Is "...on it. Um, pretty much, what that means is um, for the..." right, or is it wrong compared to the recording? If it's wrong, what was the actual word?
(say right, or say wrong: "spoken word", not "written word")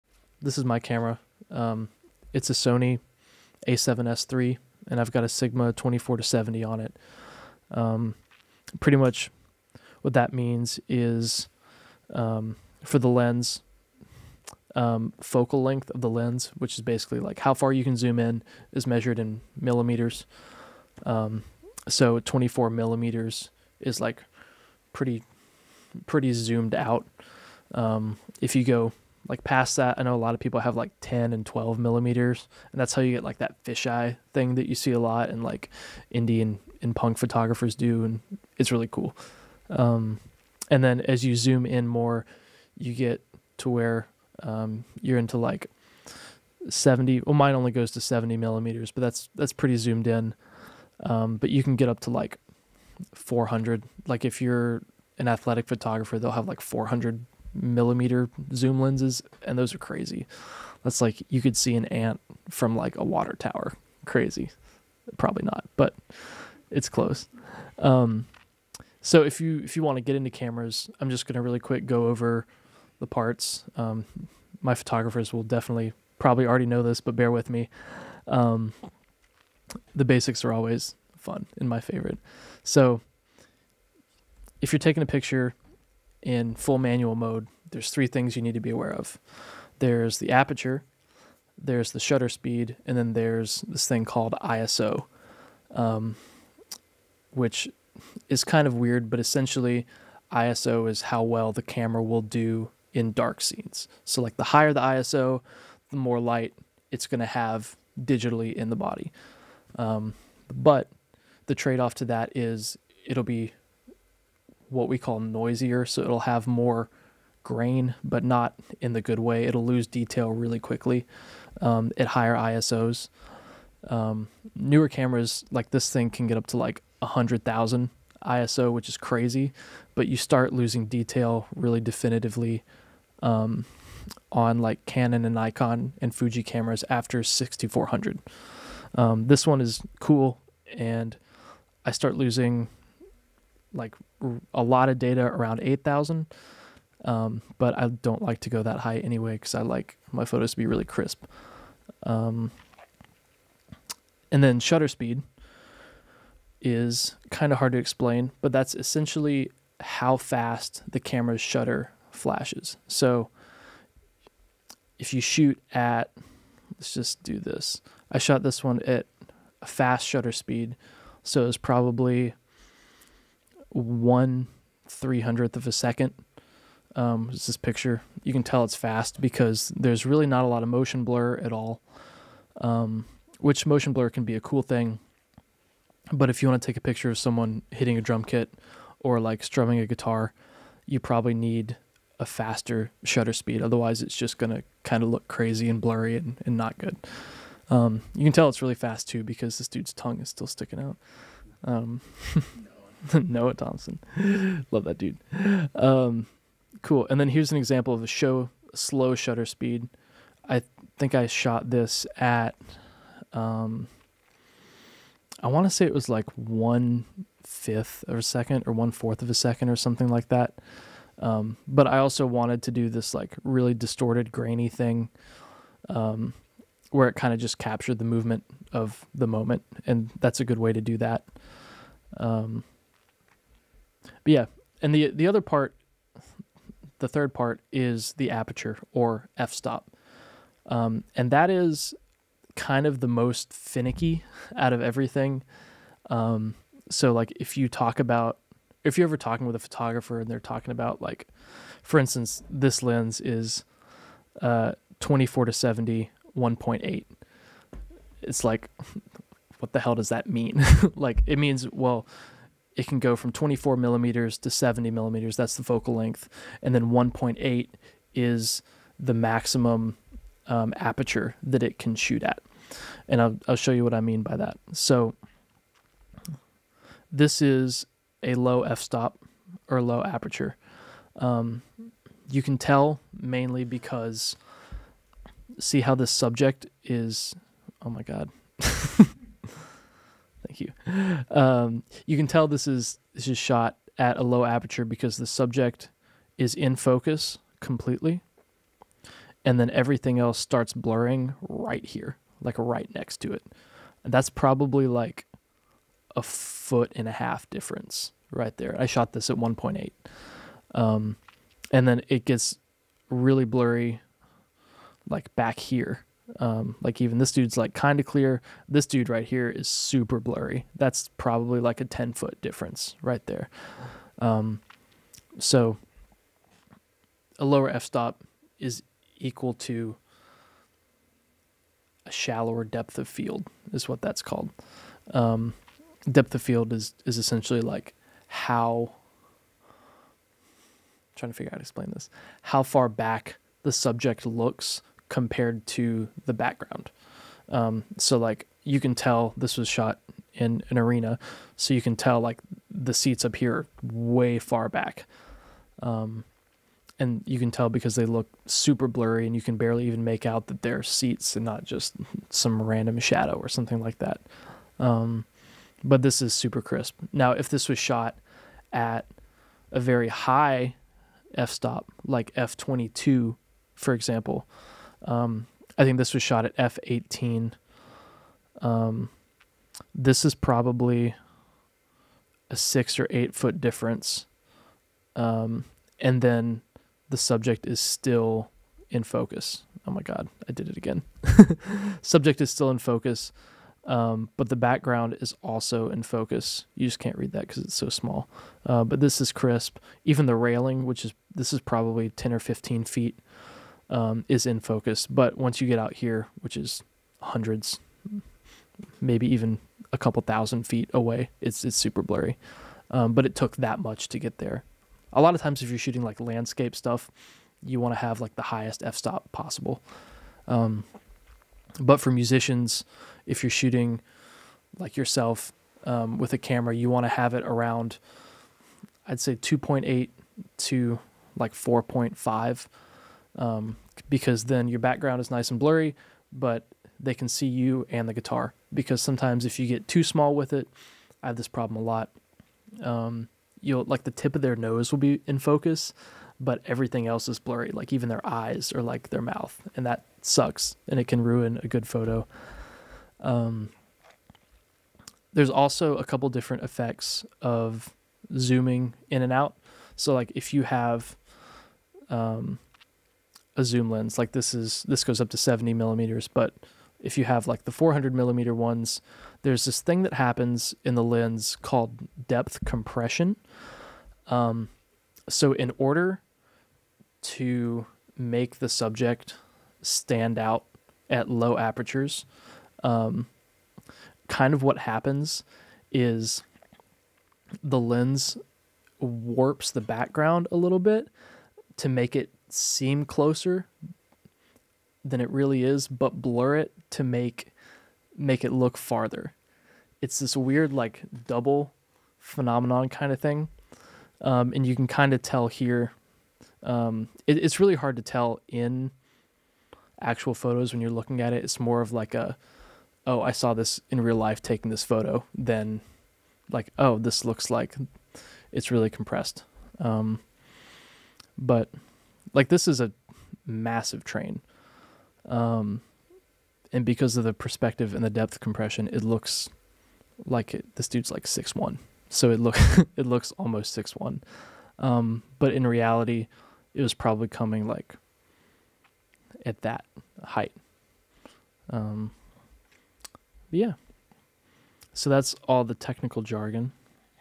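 right.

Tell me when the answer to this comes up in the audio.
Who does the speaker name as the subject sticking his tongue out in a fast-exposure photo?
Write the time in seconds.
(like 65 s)
203 s.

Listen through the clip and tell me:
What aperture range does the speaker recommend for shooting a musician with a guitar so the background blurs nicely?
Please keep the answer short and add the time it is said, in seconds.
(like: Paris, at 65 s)
2.8 to 4.5, at 429 s.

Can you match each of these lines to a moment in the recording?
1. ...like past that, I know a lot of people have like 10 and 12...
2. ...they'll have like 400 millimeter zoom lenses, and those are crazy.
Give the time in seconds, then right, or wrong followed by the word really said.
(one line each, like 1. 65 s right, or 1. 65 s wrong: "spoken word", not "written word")
1. 29 s right
2. 56 s right.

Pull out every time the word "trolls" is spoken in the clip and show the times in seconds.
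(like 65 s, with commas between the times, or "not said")
not said.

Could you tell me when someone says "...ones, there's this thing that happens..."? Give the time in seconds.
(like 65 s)
468 s.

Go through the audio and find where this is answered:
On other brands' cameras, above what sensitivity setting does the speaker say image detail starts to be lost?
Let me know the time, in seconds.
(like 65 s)
137 s.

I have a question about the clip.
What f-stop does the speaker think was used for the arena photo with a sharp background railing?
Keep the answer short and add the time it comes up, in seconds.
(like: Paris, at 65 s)
f18, at 376 s.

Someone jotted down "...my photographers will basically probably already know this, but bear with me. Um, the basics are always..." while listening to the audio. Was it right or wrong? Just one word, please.
wrong.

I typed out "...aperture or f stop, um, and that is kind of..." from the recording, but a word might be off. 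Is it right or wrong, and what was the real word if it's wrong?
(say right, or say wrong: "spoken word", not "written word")
right.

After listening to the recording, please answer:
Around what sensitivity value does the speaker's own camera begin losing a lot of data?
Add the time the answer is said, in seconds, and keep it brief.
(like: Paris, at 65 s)
8,000, at 145 s.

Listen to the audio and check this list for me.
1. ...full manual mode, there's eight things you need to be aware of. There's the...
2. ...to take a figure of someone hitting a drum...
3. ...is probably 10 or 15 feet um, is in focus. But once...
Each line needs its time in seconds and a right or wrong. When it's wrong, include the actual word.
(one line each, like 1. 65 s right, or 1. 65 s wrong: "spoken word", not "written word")
1. 86 s wrong: "three", not "eight"
2. 186 s wrong: "picture", not "figure"
3. 401 s right.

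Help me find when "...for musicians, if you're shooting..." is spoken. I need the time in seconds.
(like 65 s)
421 s.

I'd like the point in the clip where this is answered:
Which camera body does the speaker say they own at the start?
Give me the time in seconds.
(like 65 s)
2 s.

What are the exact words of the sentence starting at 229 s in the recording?
And that's a good way to do that.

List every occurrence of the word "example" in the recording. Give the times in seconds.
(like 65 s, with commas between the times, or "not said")
207 s, 373 s.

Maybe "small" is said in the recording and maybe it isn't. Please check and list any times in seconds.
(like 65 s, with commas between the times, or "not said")
397 s, 440 s.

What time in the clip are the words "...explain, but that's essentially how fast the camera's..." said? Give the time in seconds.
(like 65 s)
157 s.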